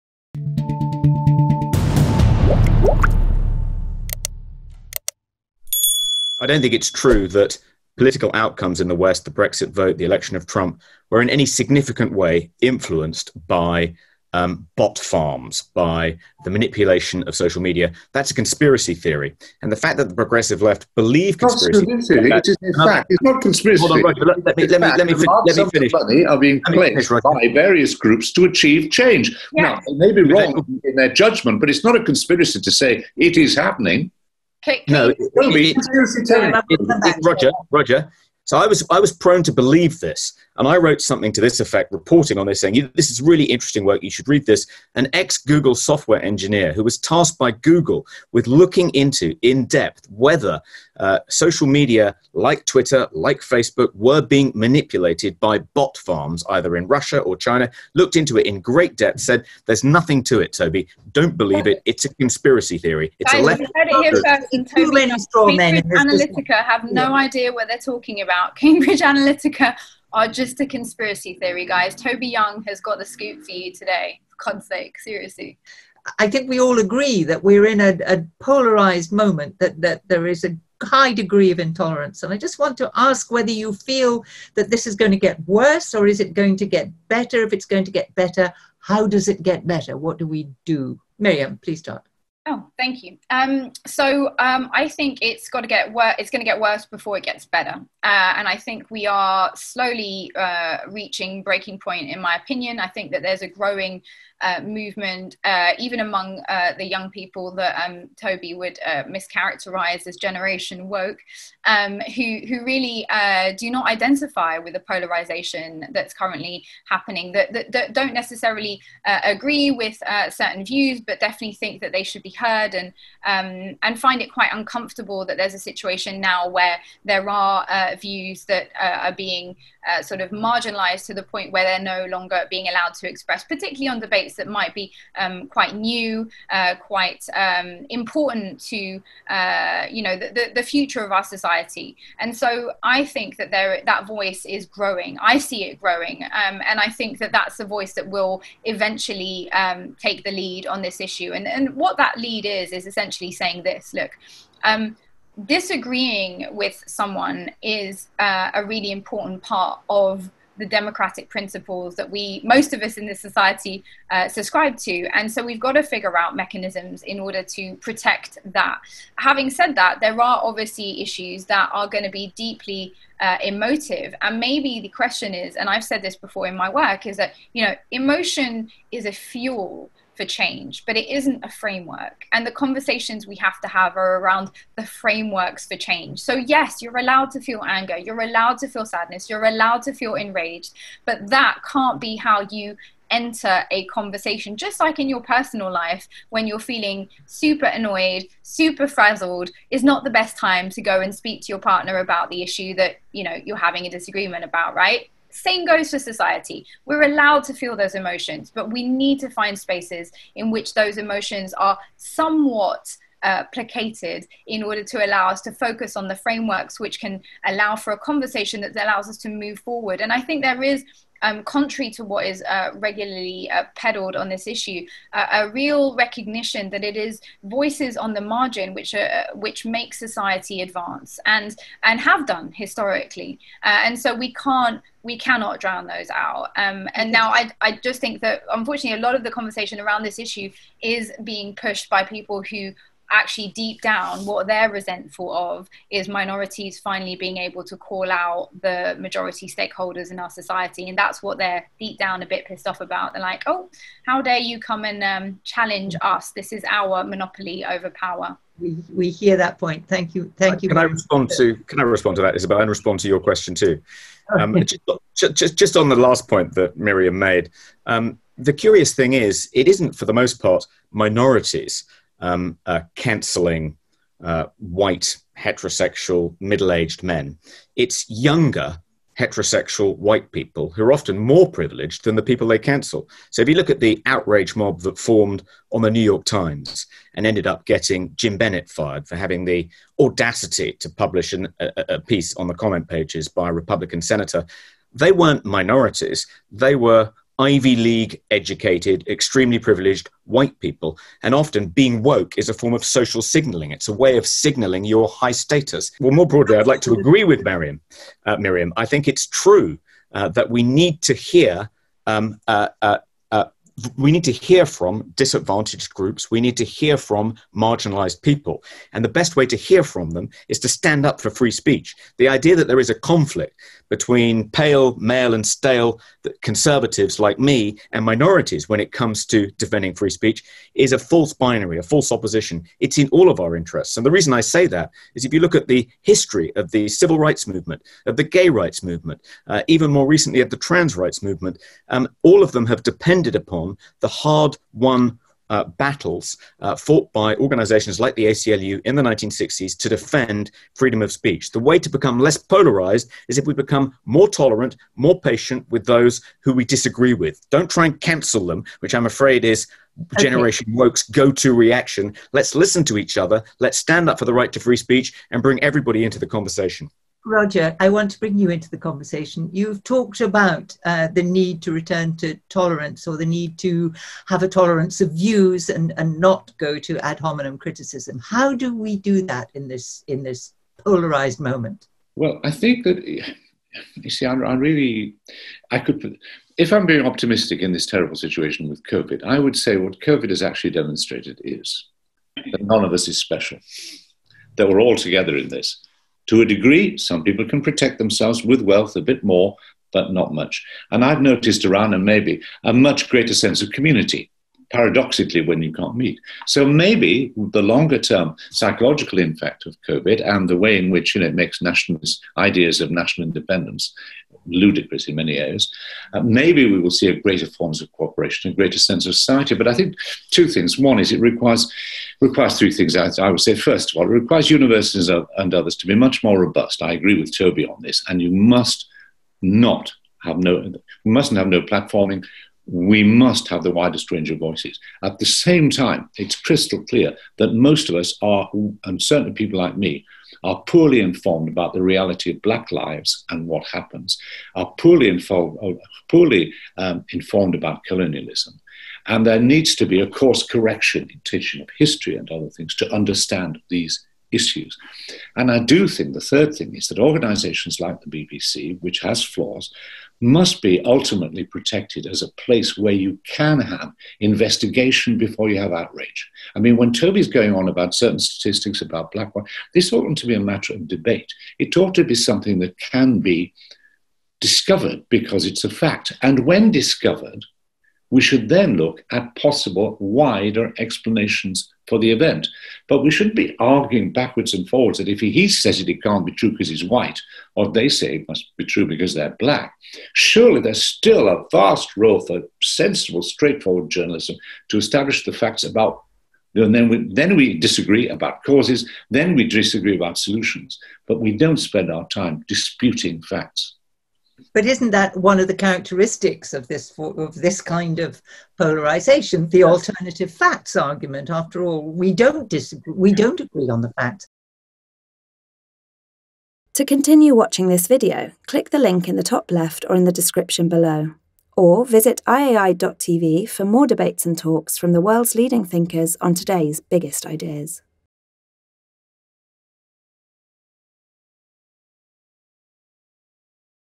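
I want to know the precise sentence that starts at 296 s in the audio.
They were Ivy League educated, extremely privileged white people.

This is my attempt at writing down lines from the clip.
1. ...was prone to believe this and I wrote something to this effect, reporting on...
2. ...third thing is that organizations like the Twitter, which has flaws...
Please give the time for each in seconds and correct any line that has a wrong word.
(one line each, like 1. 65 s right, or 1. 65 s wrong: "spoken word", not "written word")
1. 38 s right
2. 456 s wrong: "BBC", not "Twitter".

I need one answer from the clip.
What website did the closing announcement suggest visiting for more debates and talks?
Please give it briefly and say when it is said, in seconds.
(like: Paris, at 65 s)
iai.tv, at 522 s.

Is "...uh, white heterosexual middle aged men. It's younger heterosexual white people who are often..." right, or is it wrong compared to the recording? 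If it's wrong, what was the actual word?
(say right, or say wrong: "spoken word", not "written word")
right.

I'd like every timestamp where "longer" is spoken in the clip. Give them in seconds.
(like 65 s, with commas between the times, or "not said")
132 s, 407 s.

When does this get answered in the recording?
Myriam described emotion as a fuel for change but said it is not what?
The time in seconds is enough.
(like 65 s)
181 s.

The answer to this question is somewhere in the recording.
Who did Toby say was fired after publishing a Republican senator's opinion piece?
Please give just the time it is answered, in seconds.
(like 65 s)
288 s.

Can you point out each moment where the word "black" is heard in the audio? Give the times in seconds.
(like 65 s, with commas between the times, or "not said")
442 s, 469 s, 489 s.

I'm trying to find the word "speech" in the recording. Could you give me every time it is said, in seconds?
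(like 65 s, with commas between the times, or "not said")
321 s, 330 s, 351 s, 364 s.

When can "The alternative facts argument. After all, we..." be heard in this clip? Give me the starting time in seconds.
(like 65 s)
509 s.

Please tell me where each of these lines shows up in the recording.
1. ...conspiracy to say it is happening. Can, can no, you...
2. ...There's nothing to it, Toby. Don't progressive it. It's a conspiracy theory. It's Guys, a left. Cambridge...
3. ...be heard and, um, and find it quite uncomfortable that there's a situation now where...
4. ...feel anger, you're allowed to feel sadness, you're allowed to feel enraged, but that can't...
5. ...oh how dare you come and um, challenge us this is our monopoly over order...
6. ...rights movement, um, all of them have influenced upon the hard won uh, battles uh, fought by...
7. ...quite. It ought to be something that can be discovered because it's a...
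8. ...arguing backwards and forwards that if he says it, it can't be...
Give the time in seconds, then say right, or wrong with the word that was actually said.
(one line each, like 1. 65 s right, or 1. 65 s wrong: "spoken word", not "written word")
1. 32 s right
2. 59 s wrong: "believe", not "progressive"
3. 122 s right
4. 187 s right
5. 253 s wrong: "power", not "order"
6. 340 s wrong: "depended", not "influenced"
7. 470 s wrong: "debate", not "quite"
8. 483 s right.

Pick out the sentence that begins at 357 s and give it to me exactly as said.
Don't try and cancel them, which I'm afraid is okay.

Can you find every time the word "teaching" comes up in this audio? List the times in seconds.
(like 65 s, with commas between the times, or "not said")
451 s.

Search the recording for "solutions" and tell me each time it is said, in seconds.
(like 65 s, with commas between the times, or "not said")
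500 s.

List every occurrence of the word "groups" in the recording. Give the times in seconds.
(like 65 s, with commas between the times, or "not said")
27 s, 315 s.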